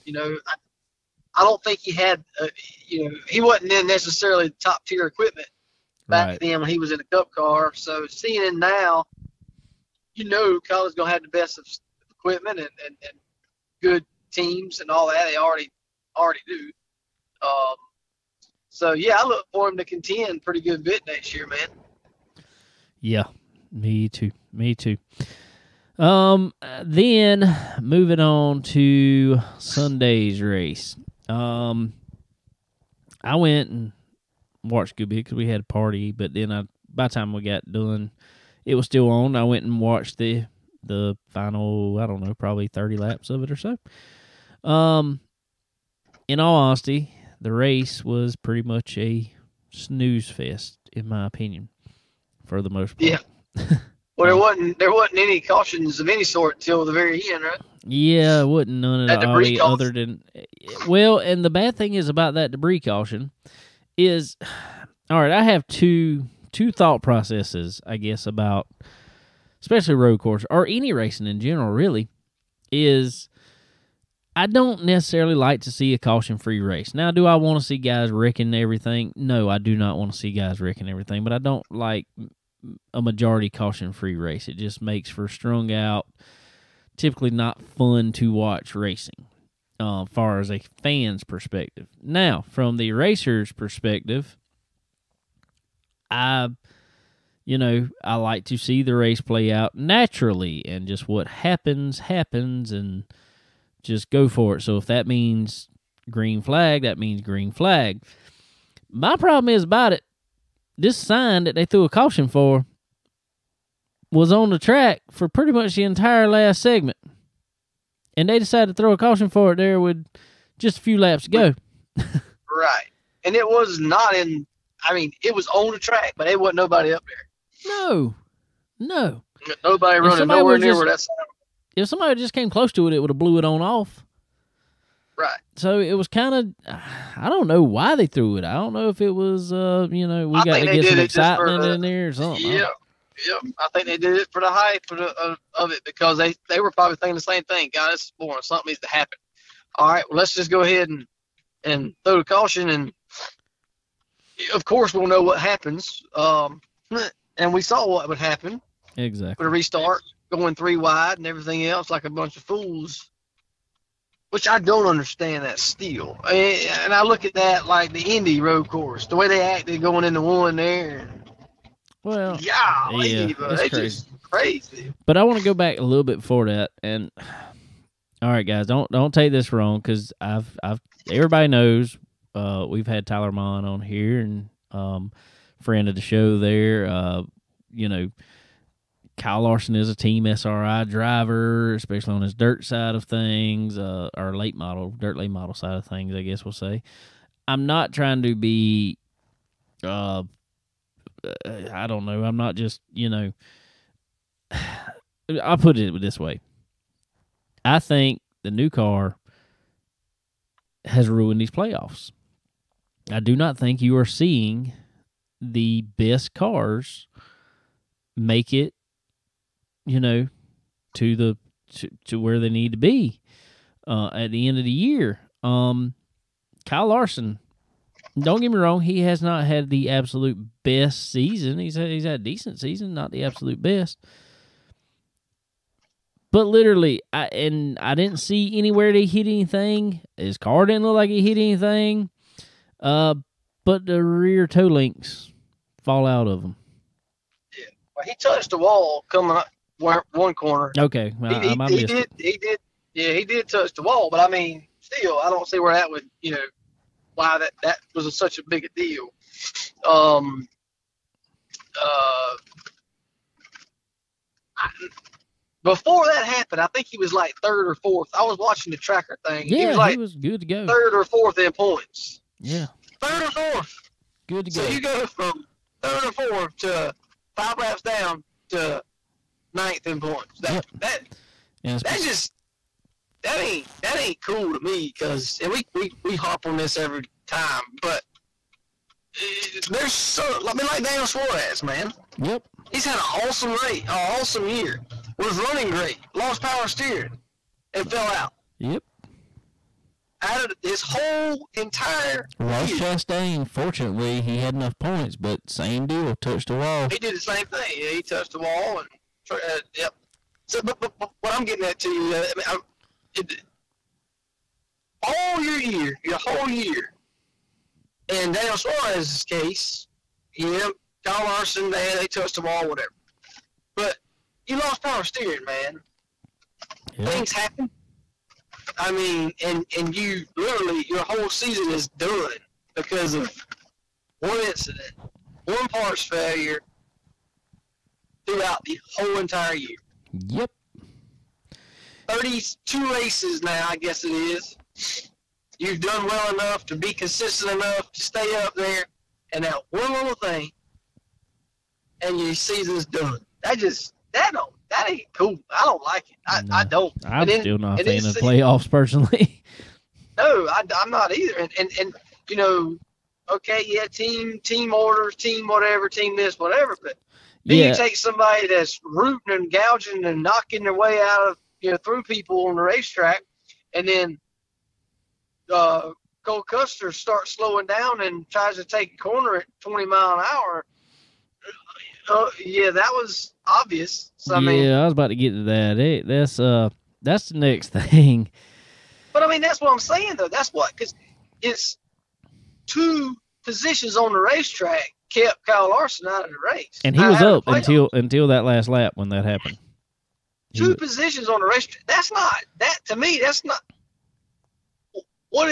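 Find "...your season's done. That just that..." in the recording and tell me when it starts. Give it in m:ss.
5:52.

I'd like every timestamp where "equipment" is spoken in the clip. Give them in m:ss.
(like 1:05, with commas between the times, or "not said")
0:05, 0:12.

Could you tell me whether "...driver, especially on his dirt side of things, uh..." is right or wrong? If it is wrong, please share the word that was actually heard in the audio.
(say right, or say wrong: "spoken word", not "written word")
right.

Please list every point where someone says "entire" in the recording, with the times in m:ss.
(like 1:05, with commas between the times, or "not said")
1:55, 5:01, 5:39.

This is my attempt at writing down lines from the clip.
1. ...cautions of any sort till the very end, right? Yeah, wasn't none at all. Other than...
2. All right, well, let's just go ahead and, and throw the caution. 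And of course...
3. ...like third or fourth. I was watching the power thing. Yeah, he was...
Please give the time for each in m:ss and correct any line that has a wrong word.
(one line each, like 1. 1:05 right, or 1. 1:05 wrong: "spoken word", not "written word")
1. 0:55 right
2. 2:29 right
3. 4:27 wrong: "tracker", not "power".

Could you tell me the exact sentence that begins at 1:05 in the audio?
I have two two thought processes, I guess, about especially road course or any racing in general.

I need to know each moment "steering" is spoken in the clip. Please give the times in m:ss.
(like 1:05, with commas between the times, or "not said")
4:56, 5:25.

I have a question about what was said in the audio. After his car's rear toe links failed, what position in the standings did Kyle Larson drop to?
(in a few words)
Ninth.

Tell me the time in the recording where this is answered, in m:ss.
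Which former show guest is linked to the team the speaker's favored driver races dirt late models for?
3:03.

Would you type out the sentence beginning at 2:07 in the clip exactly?
No, no, nobody running nowhere near just, where that's.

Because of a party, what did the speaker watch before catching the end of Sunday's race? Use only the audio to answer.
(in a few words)
Scooby.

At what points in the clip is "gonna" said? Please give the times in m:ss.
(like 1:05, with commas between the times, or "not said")
0:10.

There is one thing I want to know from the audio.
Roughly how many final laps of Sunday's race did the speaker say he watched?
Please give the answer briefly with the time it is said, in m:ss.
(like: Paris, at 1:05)
30, at 0:42.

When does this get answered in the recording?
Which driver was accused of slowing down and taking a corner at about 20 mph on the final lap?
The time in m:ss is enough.
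6:16.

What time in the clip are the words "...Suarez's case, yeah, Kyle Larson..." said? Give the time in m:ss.
5:18.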